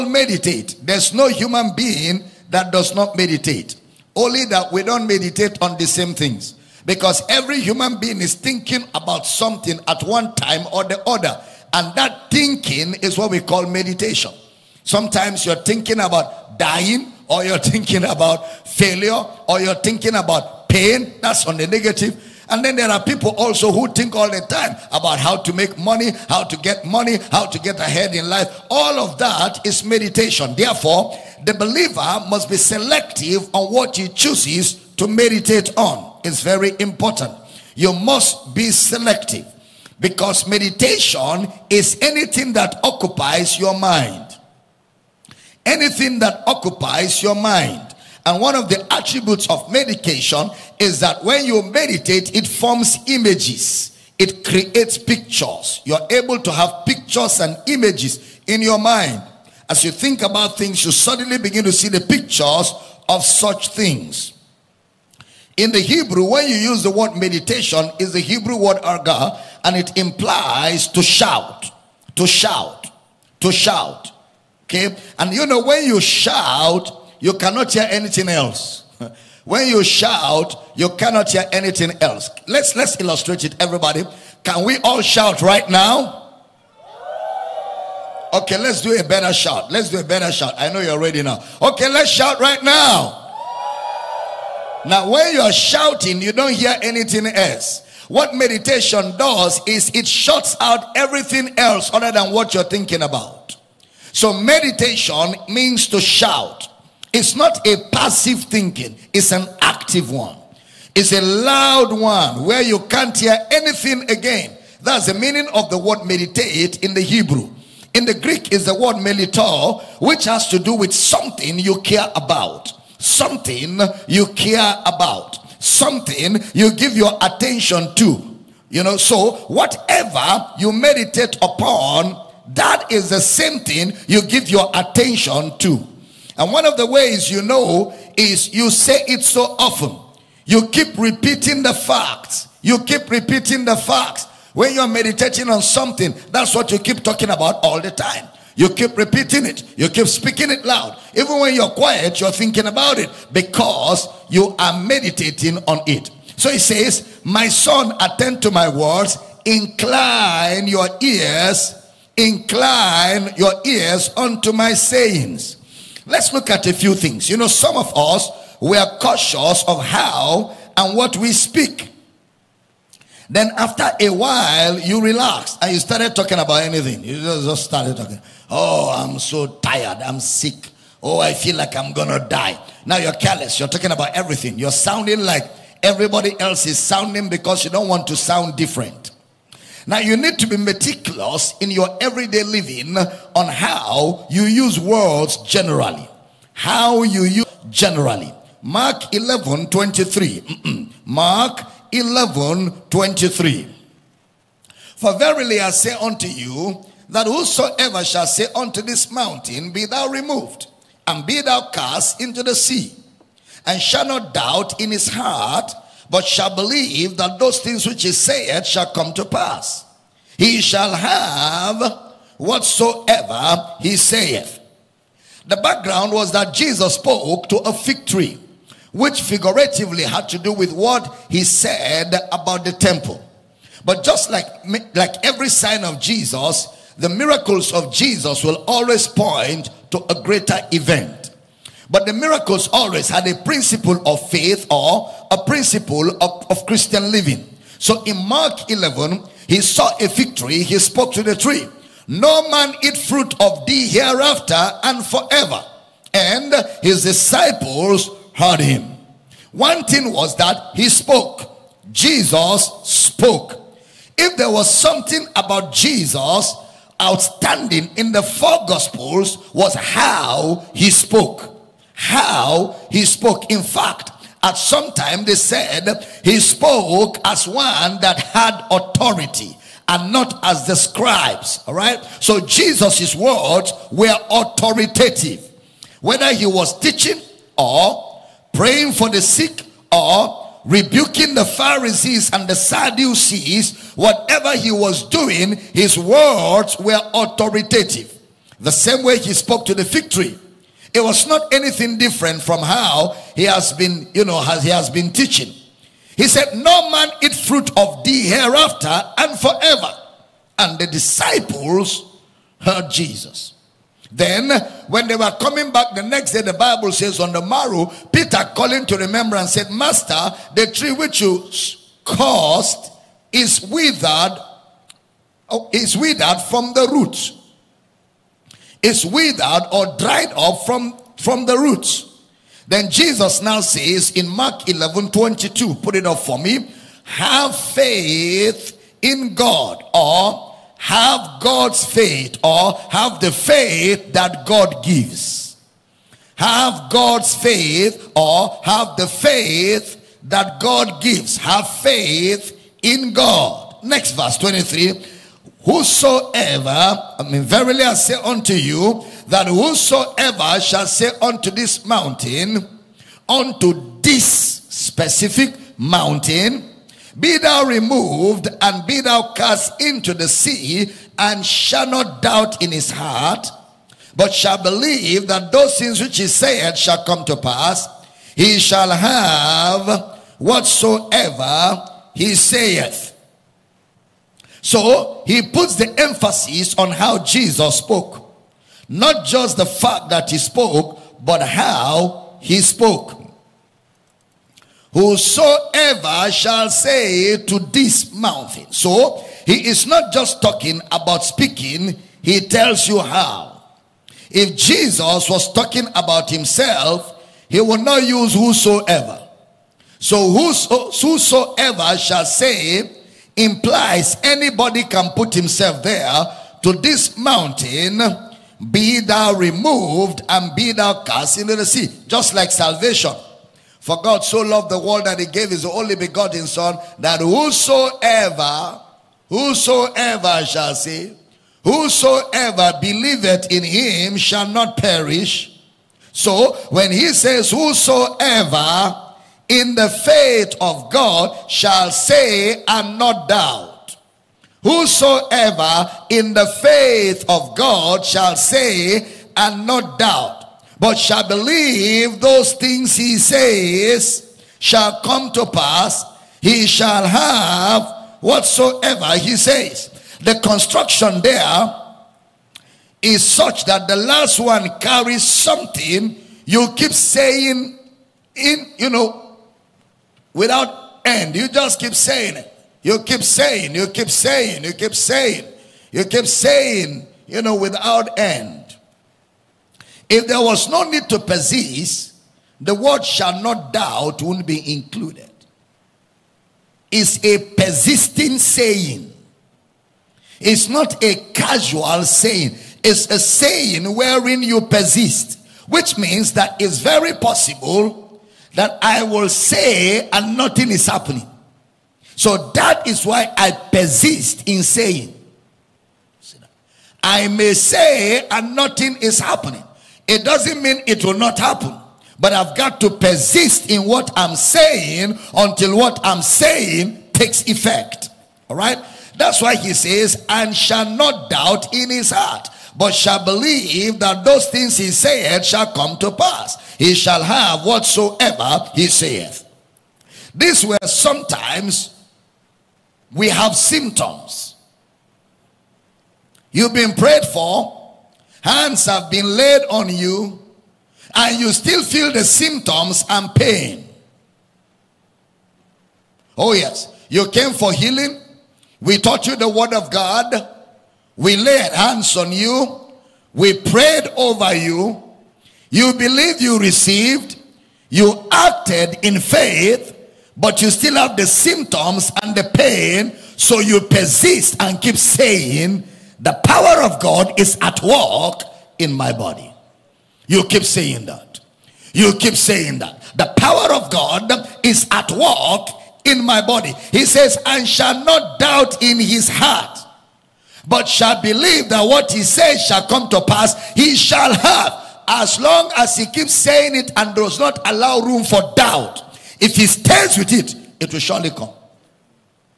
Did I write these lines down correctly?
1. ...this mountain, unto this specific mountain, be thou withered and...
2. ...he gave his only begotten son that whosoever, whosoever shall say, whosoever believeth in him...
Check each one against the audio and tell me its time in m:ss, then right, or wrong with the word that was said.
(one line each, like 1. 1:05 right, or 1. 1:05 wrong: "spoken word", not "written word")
1. 6:01 wrong: "removed", not "withered"
2. 7:05 right.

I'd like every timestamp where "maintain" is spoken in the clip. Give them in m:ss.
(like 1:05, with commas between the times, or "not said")
not said.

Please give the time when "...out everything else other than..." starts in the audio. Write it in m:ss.
1:40.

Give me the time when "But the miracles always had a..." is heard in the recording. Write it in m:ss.
4:01.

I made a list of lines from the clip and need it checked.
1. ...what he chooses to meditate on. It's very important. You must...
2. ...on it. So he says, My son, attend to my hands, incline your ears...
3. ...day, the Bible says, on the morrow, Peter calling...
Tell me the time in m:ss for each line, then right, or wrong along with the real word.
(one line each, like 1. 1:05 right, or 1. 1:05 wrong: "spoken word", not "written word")
1. 0:33 right
2. 2:35 wrong: "words", not "hands"
3. 5:16 right.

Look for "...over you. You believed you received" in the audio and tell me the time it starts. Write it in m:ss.
9:14.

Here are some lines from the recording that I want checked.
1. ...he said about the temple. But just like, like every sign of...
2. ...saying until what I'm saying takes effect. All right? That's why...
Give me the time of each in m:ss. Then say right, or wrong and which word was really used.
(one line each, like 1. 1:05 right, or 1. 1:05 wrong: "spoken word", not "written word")
1. 3:51 right
2. 8:34 right.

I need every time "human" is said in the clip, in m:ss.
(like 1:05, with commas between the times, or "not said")
0:01, 0:07.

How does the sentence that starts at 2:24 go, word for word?
When you're meditating on something, that's what you keep talking about all the time.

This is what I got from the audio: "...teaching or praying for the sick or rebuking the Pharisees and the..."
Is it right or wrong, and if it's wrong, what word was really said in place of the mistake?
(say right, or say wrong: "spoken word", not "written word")
right.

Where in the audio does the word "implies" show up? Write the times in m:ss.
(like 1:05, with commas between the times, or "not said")
1:09, 6:53.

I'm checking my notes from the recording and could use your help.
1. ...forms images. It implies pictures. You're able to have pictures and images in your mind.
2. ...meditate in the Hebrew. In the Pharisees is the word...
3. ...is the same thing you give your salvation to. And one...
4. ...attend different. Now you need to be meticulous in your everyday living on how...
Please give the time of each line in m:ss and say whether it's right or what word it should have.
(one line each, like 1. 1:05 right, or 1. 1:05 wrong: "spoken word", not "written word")
1. 0:52 wrong: "creates", not "implies"
2. 1:56 wrong: "Greek", not "Pharisees"
3. 2:12 wrong: "attention", not "salvation"
4. 3:08 wrong: "sound", not "attend".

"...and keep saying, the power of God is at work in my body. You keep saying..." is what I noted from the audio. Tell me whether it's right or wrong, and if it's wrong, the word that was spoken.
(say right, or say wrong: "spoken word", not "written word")
right.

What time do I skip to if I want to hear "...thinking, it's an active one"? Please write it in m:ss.
1:48.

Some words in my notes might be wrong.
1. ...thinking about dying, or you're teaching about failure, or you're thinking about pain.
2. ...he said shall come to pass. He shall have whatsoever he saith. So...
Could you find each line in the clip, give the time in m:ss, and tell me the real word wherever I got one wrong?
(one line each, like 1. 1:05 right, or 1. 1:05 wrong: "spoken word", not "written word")
1. 0:15 wrong: "thinking", not "teaching"
2. 6:16 right.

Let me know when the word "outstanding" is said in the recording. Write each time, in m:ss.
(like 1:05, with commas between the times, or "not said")
4:27.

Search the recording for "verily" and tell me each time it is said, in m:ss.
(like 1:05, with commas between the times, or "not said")
3:25, 5:57.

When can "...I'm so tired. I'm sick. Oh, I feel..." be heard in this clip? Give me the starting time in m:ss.
2:58.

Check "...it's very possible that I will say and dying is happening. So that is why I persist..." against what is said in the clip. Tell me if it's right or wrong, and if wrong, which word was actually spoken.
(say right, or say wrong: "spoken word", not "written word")
wrong: "nothing", not "dying".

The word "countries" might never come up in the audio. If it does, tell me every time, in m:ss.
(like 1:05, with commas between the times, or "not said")
not said.